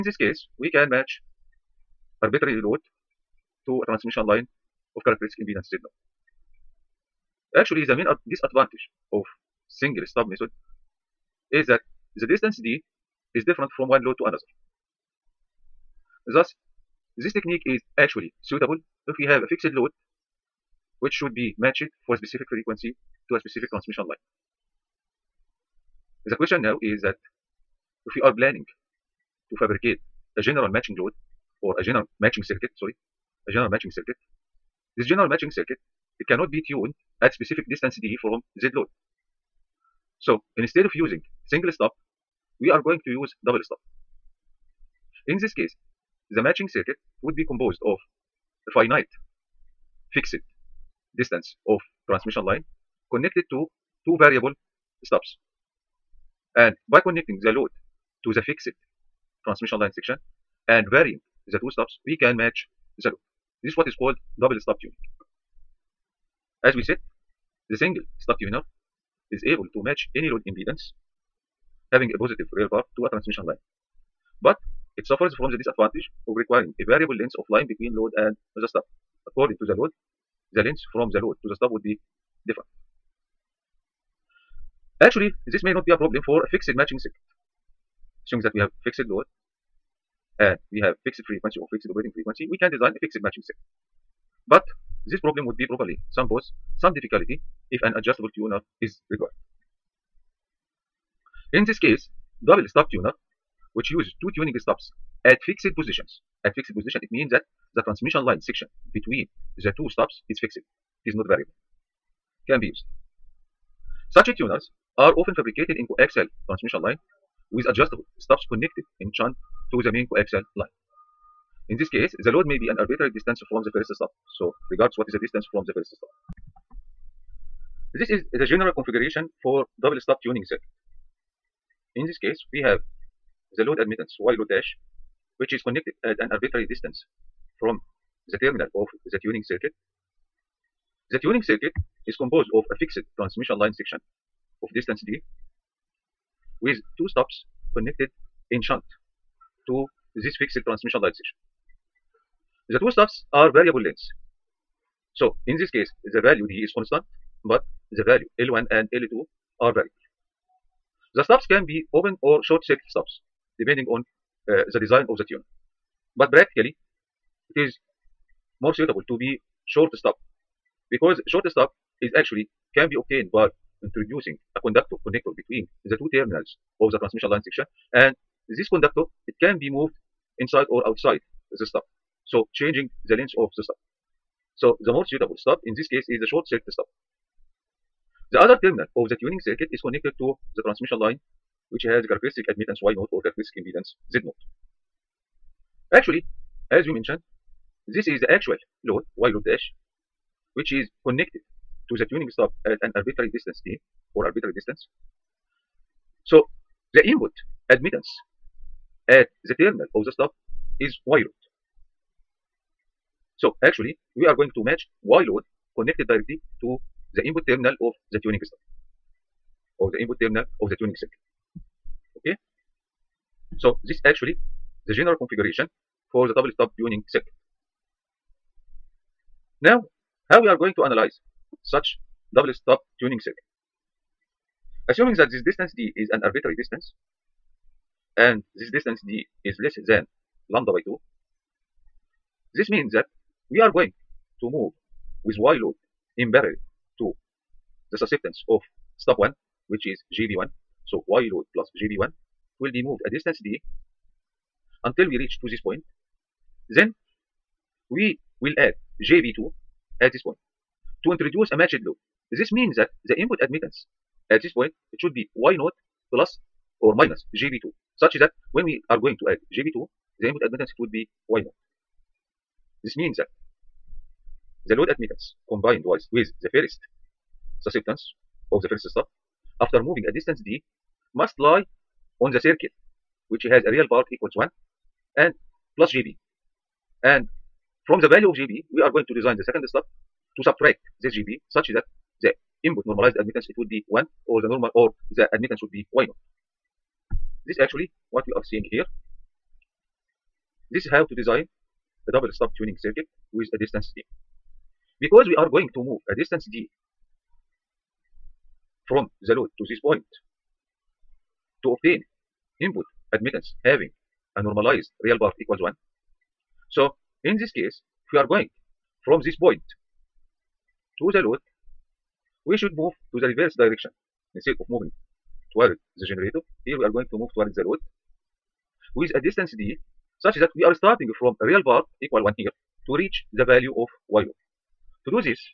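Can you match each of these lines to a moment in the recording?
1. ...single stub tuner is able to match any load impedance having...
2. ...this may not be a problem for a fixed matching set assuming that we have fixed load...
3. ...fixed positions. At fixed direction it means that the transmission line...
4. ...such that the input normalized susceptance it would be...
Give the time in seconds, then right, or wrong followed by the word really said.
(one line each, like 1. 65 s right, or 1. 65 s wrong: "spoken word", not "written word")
1. 67 s right
2. 85 s right
3. 105 s wrong: "position", not "direction"
4. 291 s wrong: "admittance", not "susceptance".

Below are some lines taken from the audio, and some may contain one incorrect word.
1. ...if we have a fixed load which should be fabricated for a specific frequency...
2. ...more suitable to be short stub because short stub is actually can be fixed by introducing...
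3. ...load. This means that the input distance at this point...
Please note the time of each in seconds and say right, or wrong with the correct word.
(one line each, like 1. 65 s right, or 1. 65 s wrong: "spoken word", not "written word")
1. 19 s wrong: "matched", not "fabricated"
2. 168 s wrong: "obtained", not "fixed"
3. 261 s wrong: "admittance", not "distance".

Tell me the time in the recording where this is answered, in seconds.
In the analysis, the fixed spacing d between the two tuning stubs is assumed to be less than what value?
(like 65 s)
240 s.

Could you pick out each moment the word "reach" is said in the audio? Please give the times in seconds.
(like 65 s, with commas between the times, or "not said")
255 s, 333 s.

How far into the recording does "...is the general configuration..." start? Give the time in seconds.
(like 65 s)
128 s.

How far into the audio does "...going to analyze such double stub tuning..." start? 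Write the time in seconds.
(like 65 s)
230 s.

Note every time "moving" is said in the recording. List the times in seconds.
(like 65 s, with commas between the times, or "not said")
279 s, 324 s.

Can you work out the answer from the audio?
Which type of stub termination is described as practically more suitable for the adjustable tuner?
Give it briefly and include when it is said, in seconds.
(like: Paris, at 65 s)
short circuit stub, at 186 s.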